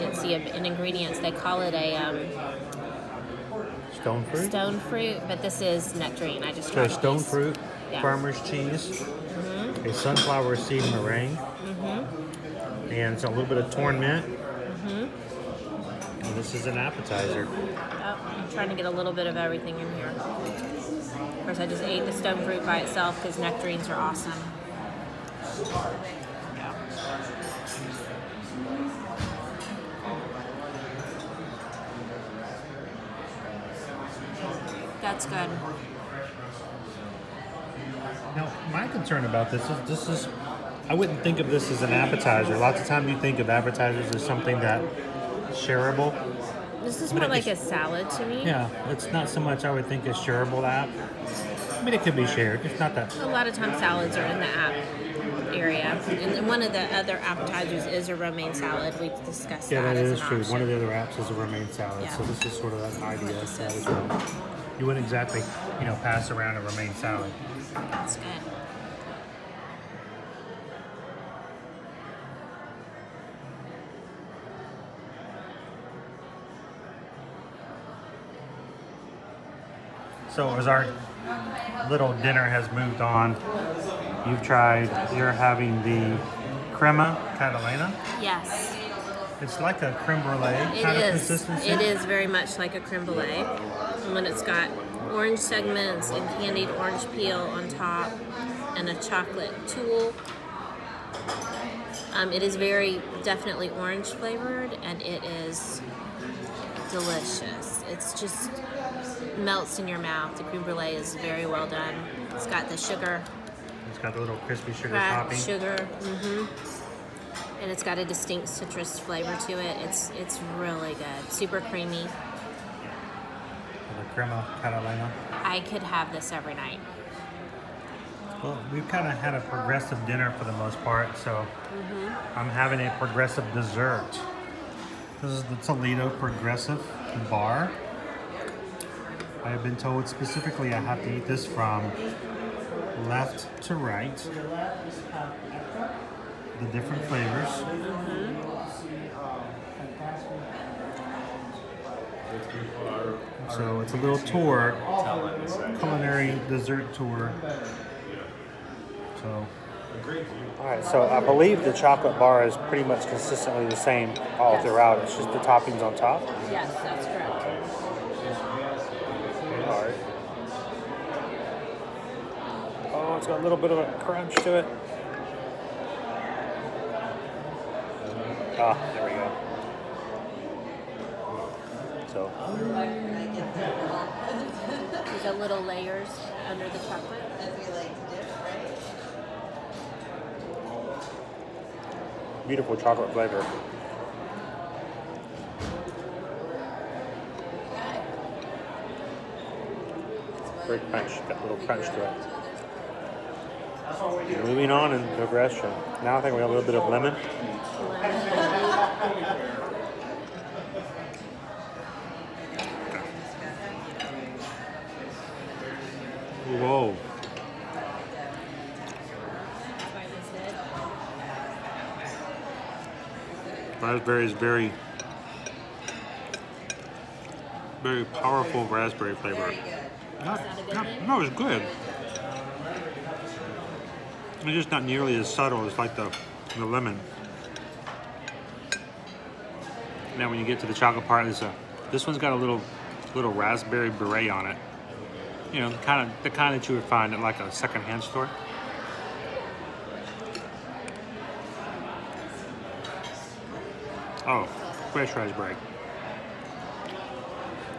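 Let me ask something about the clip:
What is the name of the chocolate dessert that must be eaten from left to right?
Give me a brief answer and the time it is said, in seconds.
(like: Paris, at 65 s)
Toledo Progressive Bar, at 135 s.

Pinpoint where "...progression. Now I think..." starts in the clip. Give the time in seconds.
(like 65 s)
205 s.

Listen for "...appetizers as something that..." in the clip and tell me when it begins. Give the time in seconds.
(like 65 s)
43 s.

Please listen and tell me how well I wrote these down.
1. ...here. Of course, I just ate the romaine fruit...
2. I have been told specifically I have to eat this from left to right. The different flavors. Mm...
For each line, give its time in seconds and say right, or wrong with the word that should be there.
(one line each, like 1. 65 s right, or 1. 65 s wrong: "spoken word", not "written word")
1. 19 s wrong: "stone", not "romaine"
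2. 139 s right.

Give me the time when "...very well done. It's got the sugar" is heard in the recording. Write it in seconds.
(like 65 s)
111 s.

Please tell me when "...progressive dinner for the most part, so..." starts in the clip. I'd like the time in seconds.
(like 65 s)
129 s.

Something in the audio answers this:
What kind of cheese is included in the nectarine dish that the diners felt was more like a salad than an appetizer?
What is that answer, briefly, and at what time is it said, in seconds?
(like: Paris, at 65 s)
farmer's cheese, at 8 s.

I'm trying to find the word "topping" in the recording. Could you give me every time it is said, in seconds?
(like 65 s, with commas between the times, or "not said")
115 s, 165 s.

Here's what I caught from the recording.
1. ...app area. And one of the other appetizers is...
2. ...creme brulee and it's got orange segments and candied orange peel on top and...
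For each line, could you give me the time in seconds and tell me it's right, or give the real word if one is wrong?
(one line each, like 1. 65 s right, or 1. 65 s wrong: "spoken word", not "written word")
1. 54 s right
2. 92 s right.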